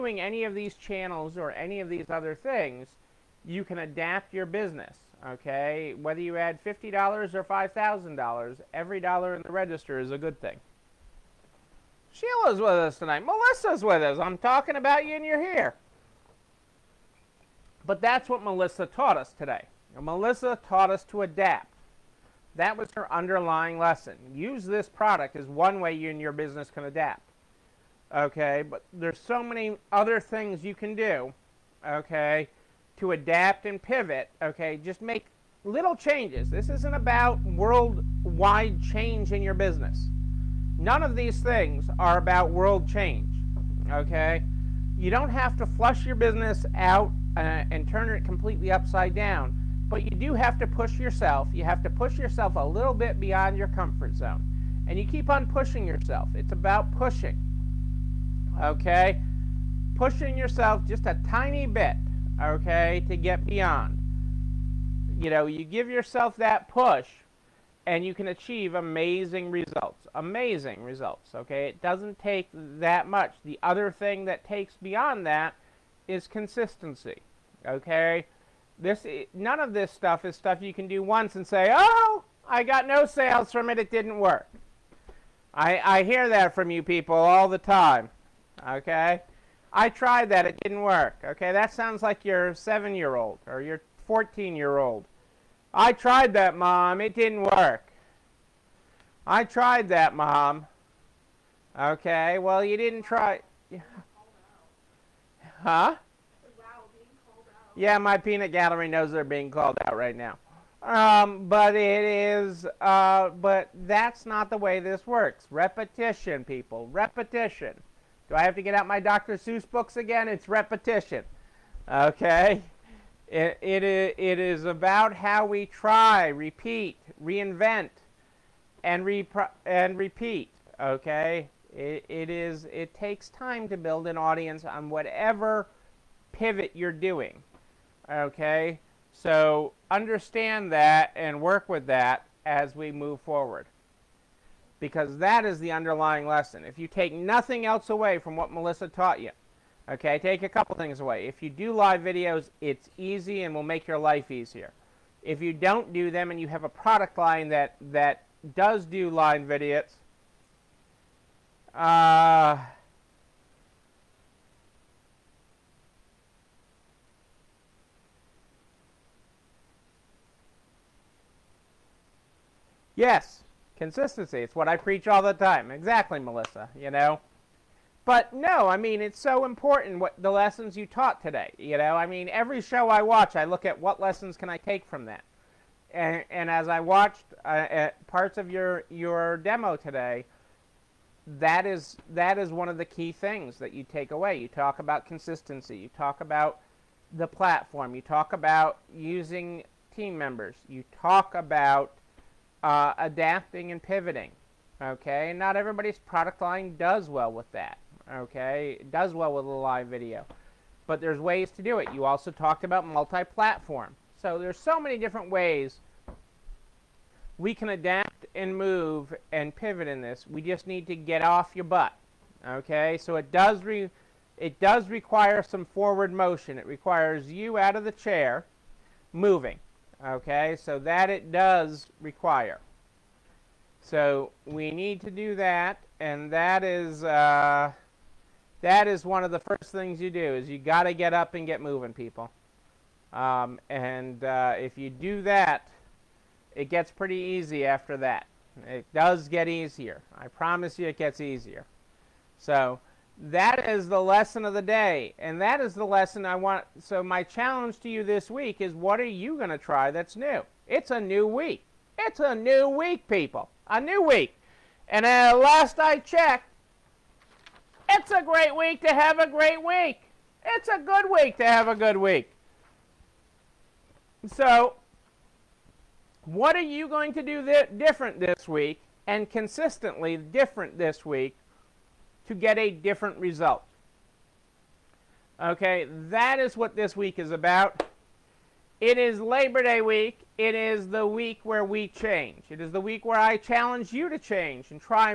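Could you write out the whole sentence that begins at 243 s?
Um, and uh, if you do that, it gets pretty easy after that.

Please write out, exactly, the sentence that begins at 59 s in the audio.
Pushing yourself just a tiny bit okay, to get beyond.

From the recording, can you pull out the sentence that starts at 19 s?
And Melissa taught us to adapt.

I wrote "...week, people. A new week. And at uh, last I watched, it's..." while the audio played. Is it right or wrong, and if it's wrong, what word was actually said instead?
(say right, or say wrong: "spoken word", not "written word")
wrong: "checked", not "watched".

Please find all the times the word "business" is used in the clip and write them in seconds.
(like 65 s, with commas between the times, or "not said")
4 s, 26 s, 39 s, 46 s.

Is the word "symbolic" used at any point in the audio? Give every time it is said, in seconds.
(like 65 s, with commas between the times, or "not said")
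not said.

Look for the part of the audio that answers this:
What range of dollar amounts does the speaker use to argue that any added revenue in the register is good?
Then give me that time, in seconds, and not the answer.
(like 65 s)
6 s.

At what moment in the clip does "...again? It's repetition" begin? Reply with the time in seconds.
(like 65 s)
119 s.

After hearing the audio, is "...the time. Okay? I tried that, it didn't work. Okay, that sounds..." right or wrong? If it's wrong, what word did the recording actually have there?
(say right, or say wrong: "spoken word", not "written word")
right.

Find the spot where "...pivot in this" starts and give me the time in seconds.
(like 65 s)
219 s.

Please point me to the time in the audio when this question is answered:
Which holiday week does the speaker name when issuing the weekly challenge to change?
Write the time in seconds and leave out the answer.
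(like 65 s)
289 s.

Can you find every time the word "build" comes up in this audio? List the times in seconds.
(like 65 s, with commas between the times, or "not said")
133 s.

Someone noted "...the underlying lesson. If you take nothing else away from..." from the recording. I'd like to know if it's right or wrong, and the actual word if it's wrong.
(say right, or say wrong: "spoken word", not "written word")
right.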